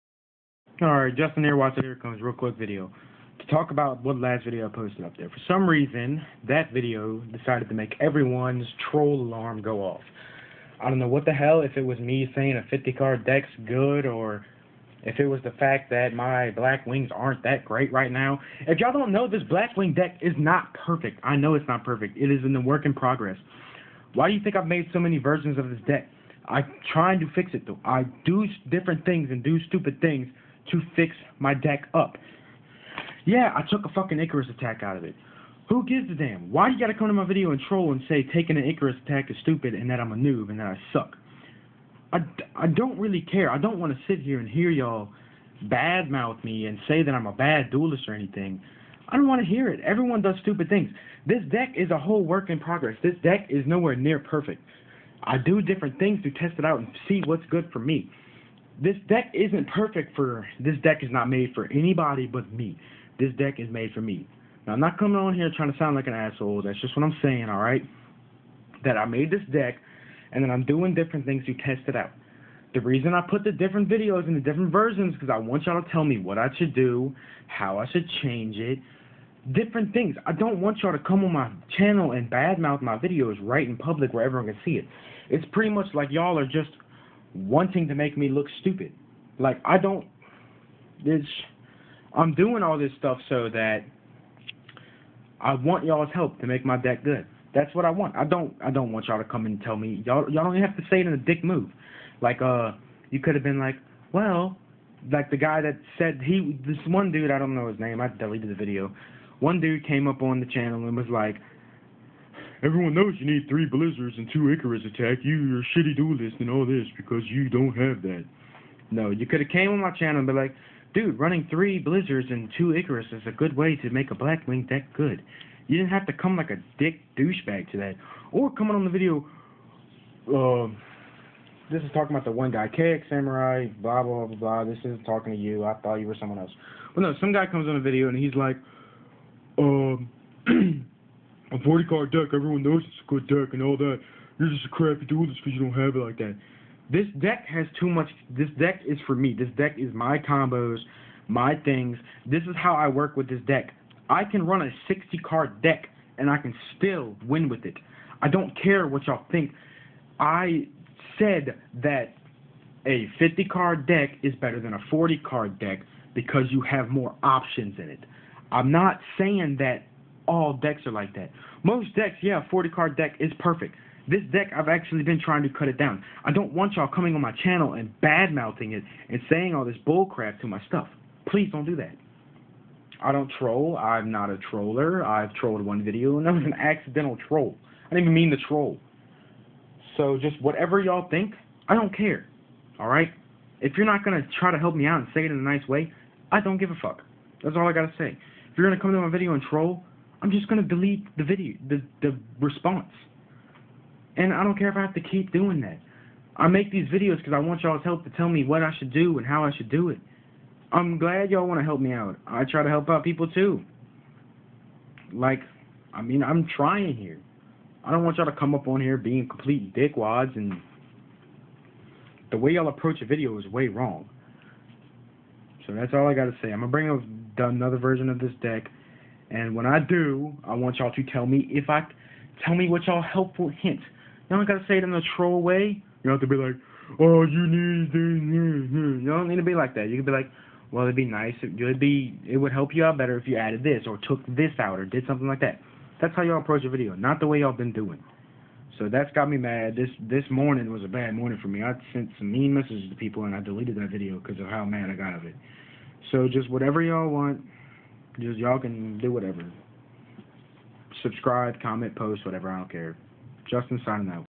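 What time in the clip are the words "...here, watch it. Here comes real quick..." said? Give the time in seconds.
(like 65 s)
1 s.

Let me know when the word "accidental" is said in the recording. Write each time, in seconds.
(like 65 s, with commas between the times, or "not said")
186 s.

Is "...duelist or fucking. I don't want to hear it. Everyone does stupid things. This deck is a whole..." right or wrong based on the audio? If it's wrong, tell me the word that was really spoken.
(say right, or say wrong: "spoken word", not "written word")
wrong: "anything", not "fucking".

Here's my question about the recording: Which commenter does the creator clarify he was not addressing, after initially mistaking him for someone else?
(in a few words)
KX Samurai.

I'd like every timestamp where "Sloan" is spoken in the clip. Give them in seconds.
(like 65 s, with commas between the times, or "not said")
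not said.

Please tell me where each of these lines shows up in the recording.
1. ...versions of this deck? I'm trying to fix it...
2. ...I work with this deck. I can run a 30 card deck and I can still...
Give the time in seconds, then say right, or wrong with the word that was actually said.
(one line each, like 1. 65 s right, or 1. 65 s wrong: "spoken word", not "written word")
1. 25 s right
2. 152 s wrong: "60", not "30".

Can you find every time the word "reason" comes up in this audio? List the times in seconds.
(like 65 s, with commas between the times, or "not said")
5 s, 72 s.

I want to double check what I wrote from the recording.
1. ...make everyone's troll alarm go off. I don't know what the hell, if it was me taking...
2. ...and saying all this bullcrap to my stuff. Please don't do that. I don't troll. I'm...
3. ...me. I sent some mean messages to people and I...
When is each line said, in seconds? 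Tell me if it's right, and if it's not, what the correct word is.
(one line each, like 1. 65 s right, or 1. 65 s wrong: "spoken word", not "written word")
1. 7 s wrong: "saying", not "taking"
2. 179 s right
3. 251 s right.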